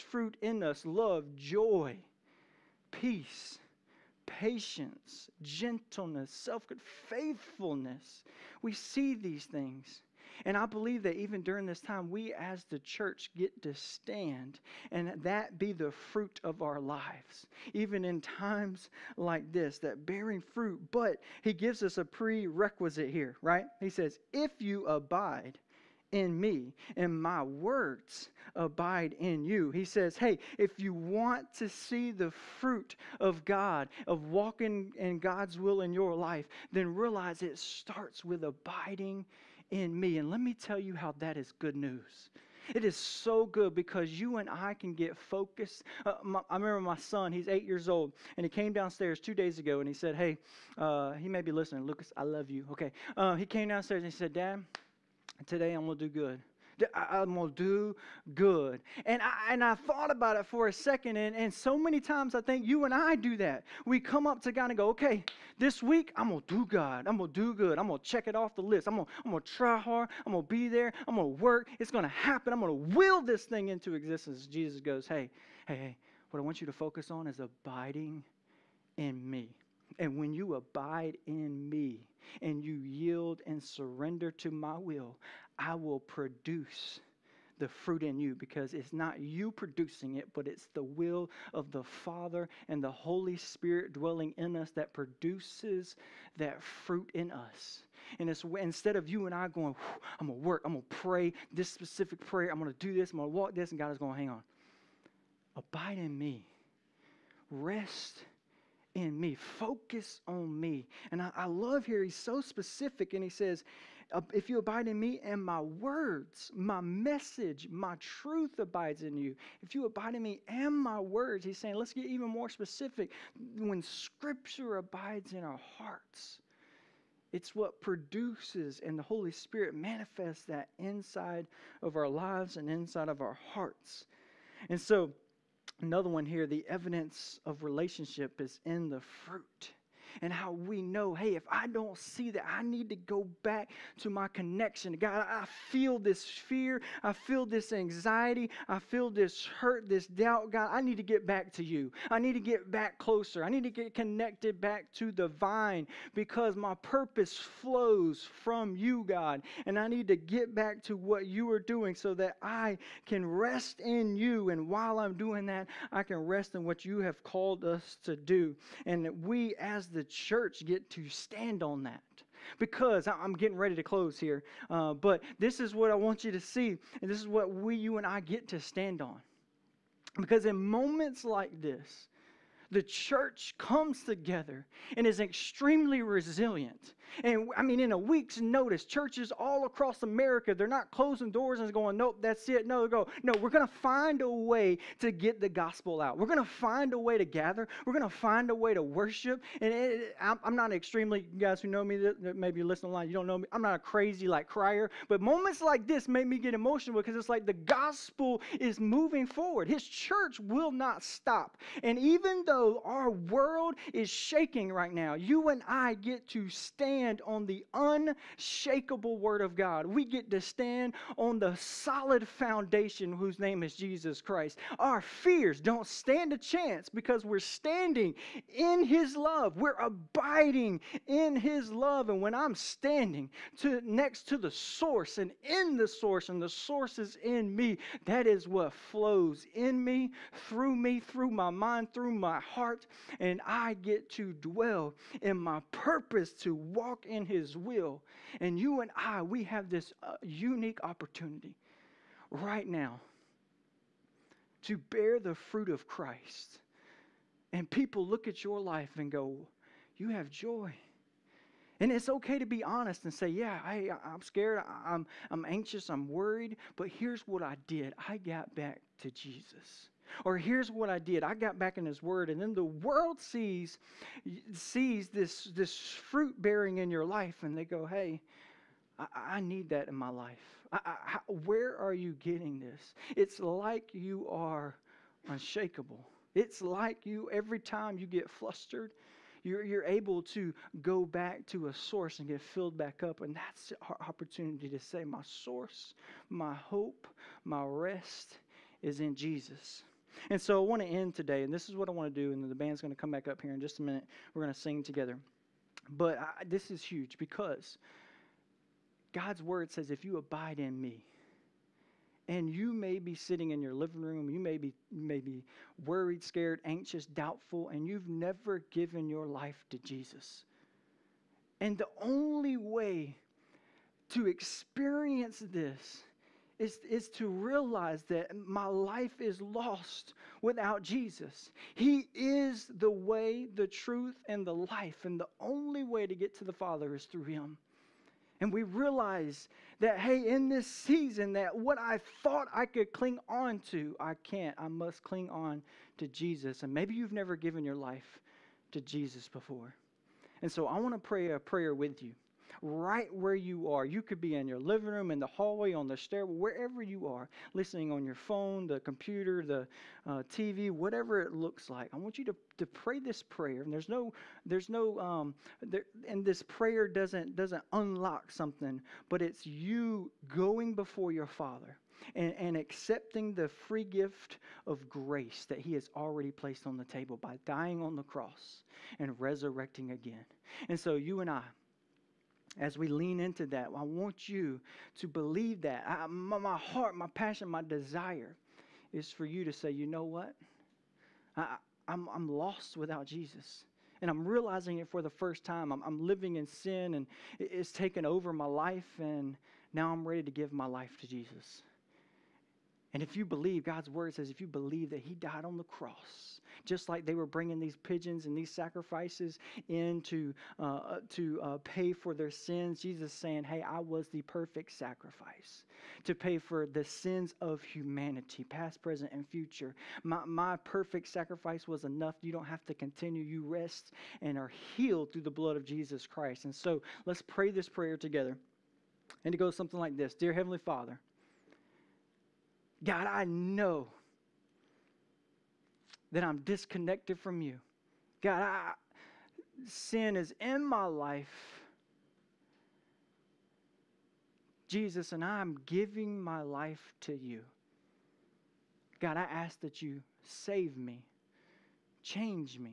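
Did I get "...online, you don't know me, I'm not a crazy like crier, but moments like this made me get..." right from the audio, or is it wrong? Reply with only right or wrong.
right.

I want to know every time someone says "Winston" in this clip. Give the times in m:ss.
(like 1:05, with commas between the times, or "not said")
not said.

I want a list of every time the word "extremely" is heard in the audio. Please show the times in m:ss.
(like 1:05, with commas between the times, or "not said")
3:05, 3:20.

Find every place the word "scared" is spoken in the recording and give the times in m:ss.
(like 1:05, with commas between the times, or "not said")
4:24, 5:16.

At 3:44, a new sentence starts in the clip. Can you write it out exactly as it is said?
Our fears don't stand a chance because we're standing in His love.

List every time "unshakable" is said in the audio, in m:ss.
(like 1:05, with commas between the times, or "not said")
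3:37, 4:45.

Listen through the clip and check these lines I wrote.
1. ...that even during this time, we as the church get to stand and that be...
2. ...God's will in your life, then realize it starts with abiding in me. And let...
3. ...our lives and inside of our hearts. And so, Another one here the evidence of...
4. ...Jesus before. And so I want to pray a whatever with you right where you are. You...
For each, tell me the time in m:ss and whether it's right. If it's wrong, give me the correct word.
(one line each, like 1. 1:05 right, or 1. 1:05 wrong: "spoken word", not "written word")
1. 0:11 right
2. 0:35 right
3. 2:11 right
4. 5:48 wrong: "prayer", not "whatever".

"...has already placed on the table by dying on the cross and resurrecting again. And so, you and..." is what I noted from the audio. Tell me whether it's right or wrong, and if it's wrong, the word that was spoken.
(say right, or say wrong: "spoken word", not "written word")
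right.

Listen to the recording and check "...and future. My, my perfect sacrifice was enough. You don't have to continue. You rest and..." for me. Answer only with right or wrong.
right.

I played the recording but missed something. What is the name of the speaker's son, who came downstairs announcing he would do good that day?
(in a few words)
Lucas.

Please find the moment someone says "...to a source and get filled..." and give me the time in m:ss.
4:51.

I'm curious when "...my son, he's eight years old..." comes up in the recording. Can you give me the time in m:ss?
0:46.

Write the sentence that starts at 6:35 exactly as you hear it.
I'm, I'm living in sin and it's taken over my life, and now I'm ready to give my life to Jesus.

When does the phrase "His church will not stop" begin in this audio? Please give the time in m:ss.
3:29.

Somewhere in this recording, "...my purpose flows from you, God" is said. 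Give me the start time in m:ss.
2:36.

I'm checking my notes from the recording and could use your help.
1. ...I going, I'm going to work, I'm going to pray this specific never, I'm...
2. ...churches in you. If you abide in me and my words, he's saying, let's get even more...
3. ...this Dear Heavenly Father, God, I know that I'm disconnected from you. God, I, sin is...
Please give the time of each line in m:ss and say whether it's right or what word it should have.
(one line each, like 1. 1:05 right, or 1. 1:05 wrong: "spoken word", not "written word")
1. 1:39 wrong: "prayer", not "never"
2. 1:58 wrong: "abides", not "churches"
3. 7:09 right.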